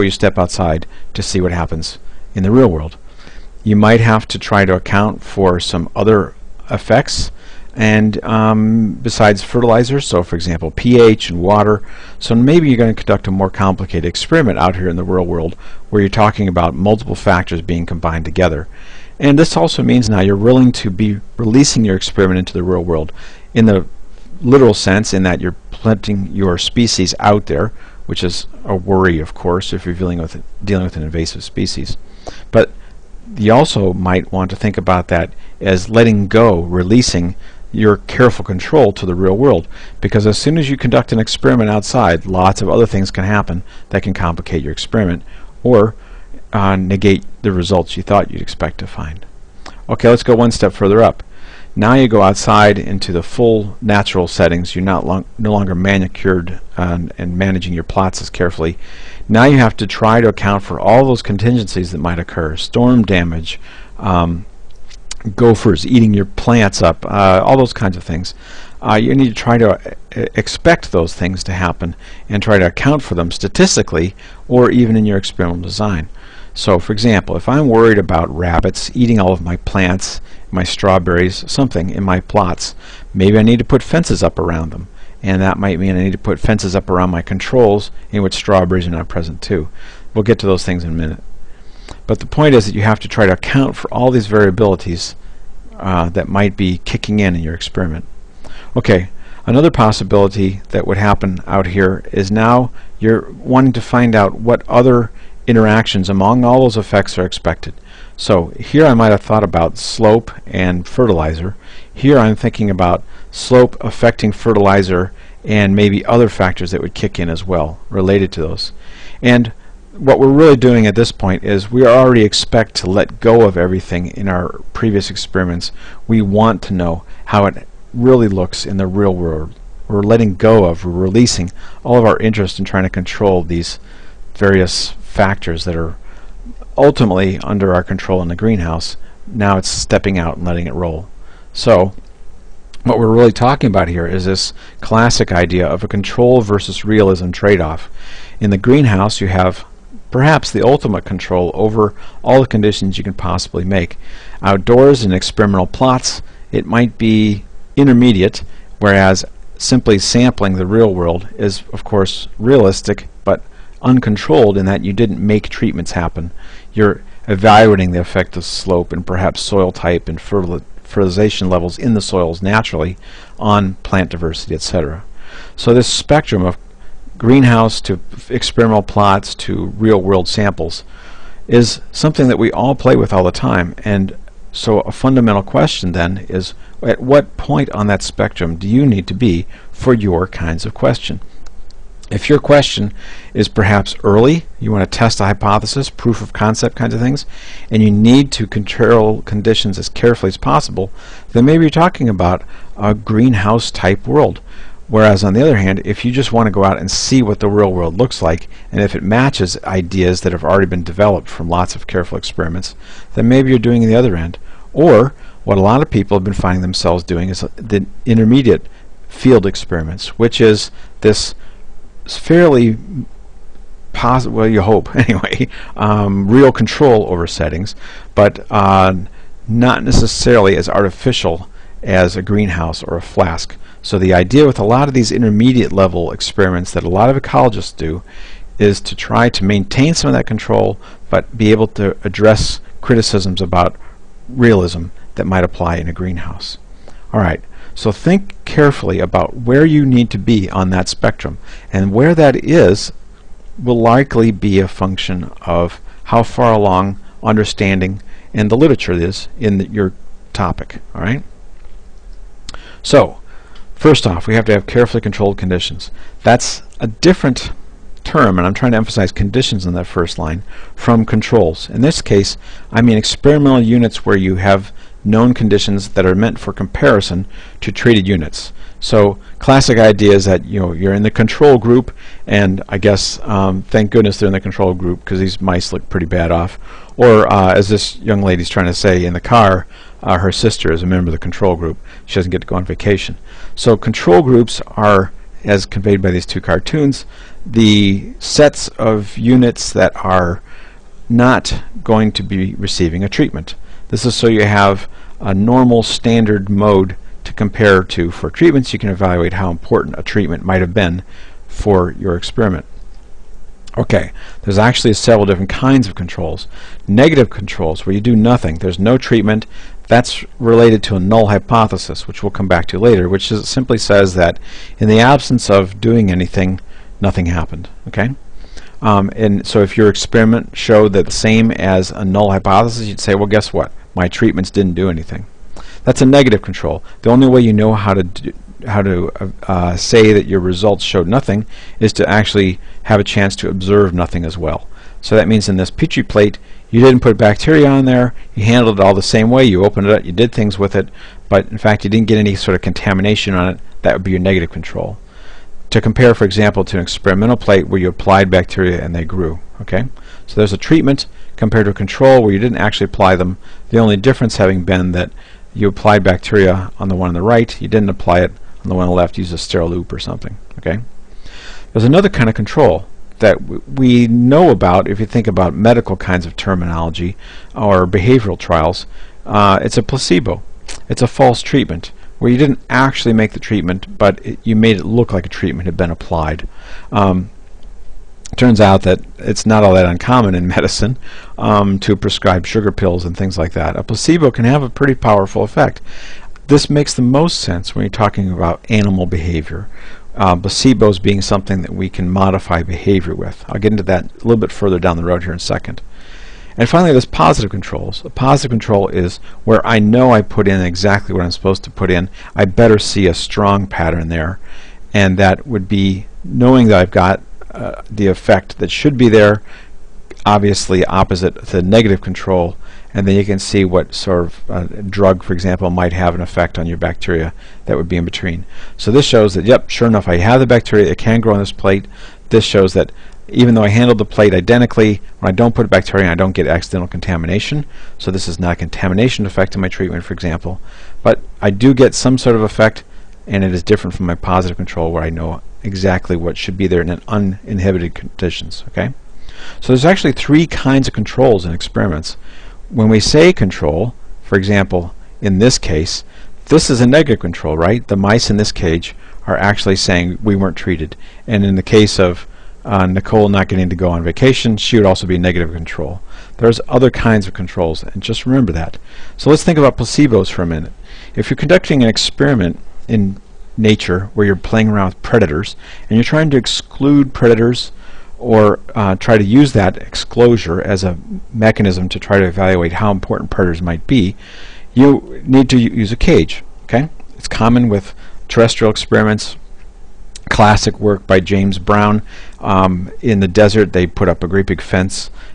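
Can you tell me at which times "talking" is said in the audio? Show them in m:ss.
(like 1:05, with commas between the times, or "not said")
0:16, 2:23, 3:21, 6:37.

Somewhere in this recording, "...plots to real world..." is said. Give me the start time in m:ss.
2:58.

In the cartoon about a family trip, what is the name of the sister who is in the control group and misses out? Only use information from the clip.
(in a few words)
Nicole.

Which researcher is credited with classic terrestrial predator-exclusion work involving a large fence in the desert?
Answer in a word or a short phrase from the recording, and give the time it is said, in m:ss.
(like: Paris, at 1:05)
James Brown, at 8:11.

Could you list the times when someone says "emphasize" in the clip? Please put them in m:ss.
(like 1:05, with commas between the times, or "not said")
4:28.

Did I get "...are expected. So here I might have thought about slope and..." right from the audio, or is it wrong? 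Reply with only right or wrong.
right.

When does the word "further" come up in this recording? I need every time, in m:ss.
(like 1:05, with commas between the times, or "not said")
0:50, 6:44.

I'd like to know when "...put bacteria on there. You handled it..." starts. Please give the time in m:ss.
5:47.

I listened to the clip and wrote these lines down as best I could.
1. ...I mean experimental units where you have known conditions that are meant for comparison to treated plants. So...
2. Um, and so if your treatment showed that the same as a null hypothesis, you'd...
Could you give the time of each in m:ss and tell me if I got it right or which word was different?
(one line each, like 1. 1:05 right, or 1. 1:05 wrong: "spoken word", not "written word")
1. 4:32 wrong: "units", not "plants"
2. 5:28 wrong: "experiment", not "treatment".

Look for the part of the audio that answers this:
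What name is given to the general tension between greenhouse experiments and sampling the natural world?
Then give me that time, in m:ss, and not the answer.
2:25.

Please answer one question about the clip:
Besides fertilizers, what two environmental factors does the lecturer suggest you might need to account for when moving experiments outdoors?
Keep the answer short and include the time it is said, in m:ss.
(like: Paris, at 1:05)
pH and water, at 0:10.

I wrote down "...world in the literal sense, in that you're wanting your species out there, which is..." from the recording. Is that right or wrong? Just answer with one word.
wrong.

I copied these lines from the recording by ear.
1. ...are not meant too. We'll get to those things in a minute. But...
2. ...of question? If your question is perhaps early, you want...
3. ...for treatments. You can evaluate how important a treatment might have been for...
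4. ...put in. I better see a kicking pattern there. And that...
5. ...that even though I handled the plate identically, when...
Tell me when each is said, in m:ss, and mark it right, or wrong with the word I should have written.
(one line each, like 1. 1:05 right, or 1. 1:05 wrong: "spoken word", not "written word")
1. 1:28 wrong: "present", not "meant"
2. 3:10 right
3. 5:08 right
4. 6:51 wrong: "strong", not "kicking"
5. 7:12 right.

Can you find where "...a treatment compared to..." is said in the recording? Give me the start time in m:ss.
6:00.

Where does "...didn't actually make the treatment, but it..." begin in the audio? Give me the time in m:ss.
6:22.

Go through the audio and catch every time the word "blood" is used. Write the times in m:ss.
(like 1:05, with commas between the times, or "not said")
not said.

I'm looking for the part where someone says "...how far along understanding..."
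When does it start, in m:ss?
4:16.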